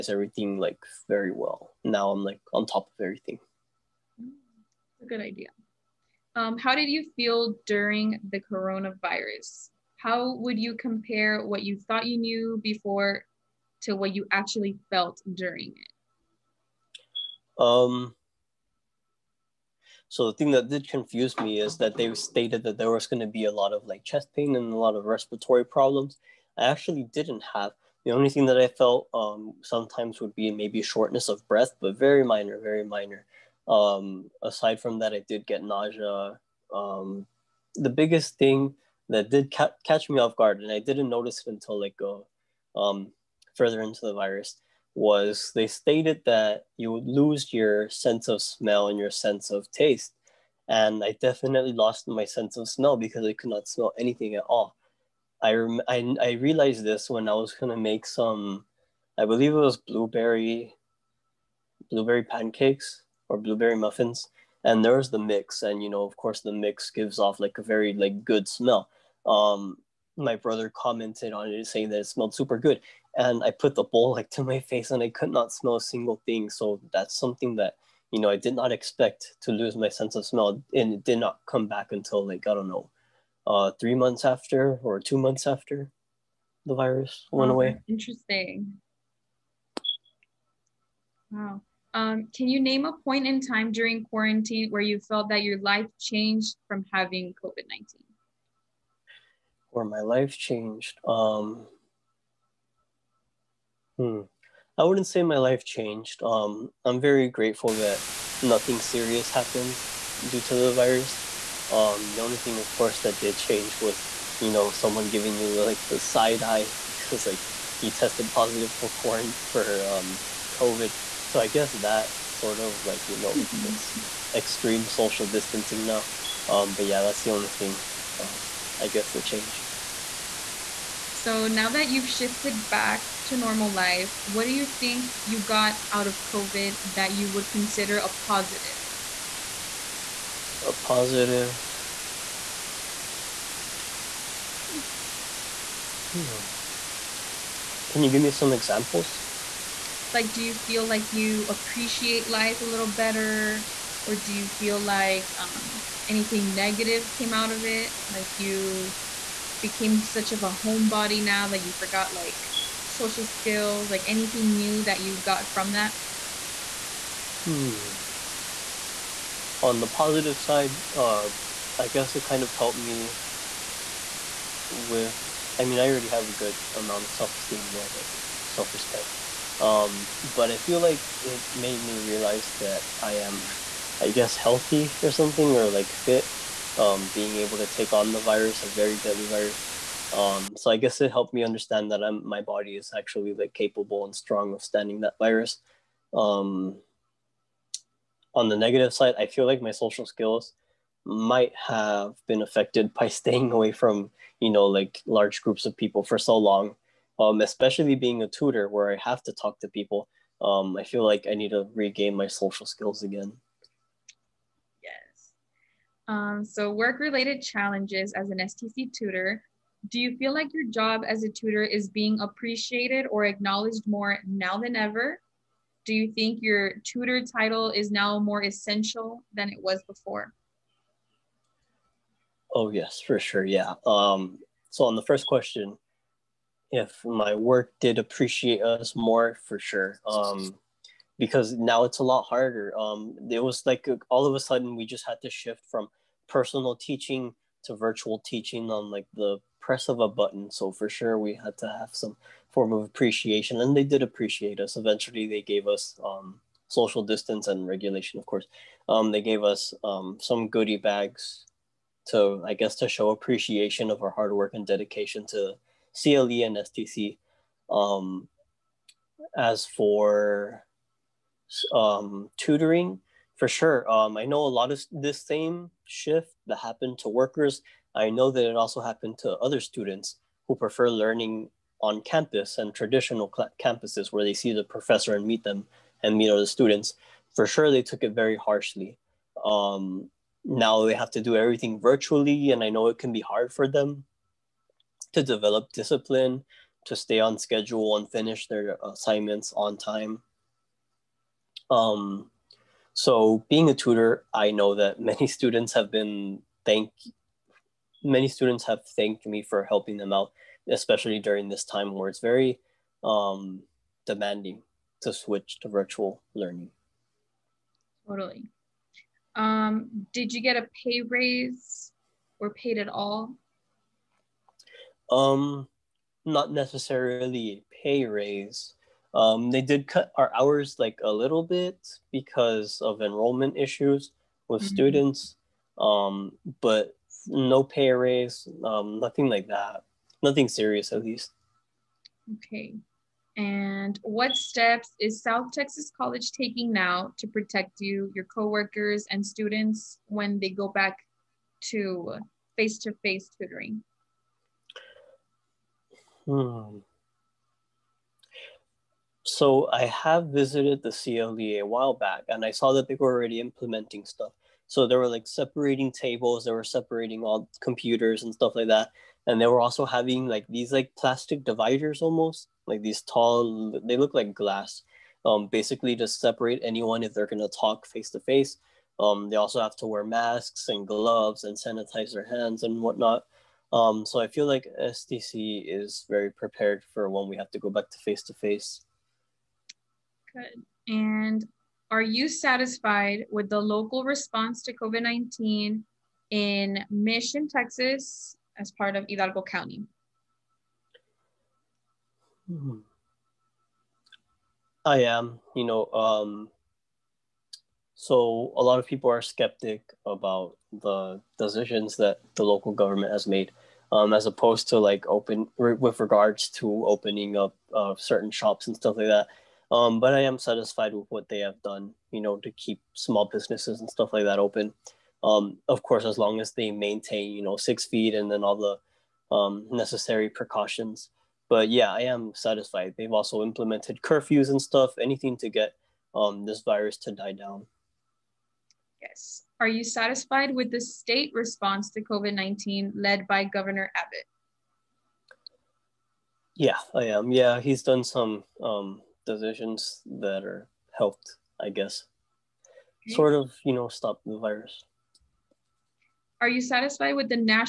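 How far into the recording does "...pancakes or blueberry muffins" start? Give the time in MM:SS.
01:02.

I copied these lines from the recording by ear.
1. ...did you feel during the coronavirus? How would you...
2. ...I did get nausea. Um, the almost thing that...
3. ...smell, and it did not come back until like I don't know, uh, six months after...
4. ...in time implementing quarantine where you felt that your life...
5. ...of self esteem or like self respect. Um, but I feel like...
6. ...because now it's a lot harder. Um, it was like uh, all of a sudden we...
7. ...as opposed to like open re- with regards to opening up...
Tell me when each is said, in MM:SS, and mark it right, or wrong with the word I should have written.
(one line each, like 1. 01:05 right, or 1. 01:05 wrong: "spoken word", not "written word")
1. 00:06 right
2. 00:35 wrong: "biggest", not "almost"
3. 01:20 wrong: "three", not "six"
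4. 01:33 wrong: "during", not "implementing"
5. 02:57 right
6. 04:01 right
7. 06:54 right.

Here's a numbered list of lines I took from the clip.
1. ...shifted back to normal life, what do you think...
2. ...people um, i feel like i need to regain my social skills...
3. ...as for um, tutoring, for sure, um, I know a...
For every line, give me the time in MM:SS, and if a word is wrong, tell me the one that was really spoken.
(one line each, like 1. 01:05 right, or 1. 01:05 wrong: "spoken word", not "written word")
1. 02:12 right
2. 03:29 right
3. 04:29 right.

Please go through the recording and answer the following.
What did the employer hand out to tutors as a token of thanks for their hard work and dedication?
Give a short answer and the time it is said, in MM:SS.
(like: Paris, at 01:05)
Goodie bags, at 04:20.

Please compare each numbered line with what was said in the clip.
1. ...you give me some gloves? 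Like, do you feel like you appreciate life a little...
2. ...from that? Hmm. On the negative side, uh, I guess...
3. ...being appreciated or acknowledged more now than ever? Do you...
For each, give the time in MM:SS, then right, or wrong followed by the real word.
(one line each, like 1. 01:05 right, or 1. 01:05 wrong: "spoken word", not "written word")
1. 02:28 wrong: "examples", not "gloves"
2. 02:45 wrong: "positive", not "negative"
3. 03:41 right.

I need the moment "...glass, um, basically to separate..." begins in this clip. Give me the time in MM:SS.
06:14.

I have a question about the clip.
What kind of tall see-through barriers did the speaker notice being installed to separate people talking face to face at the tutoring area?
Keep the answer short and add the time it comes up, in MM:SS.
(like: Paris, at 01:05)
Plastic dividers, at 06:10.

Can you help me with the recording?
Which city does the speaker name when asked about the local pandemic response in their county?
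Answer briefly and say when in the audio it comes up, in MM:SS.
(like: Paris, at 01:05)
Mission, Texas, at 06:36.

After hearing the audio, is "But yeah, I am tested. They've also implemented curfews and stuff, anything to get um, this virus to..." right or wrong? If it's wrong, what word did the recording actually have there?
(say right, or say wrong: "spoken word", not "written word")
wrong: "satisfied", not "tested".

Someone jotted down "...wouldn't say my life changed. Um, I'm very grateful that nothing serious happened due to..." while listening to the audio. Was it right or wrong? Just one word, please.
right.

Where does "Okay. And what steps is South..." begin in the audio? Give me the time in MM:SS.
05:42.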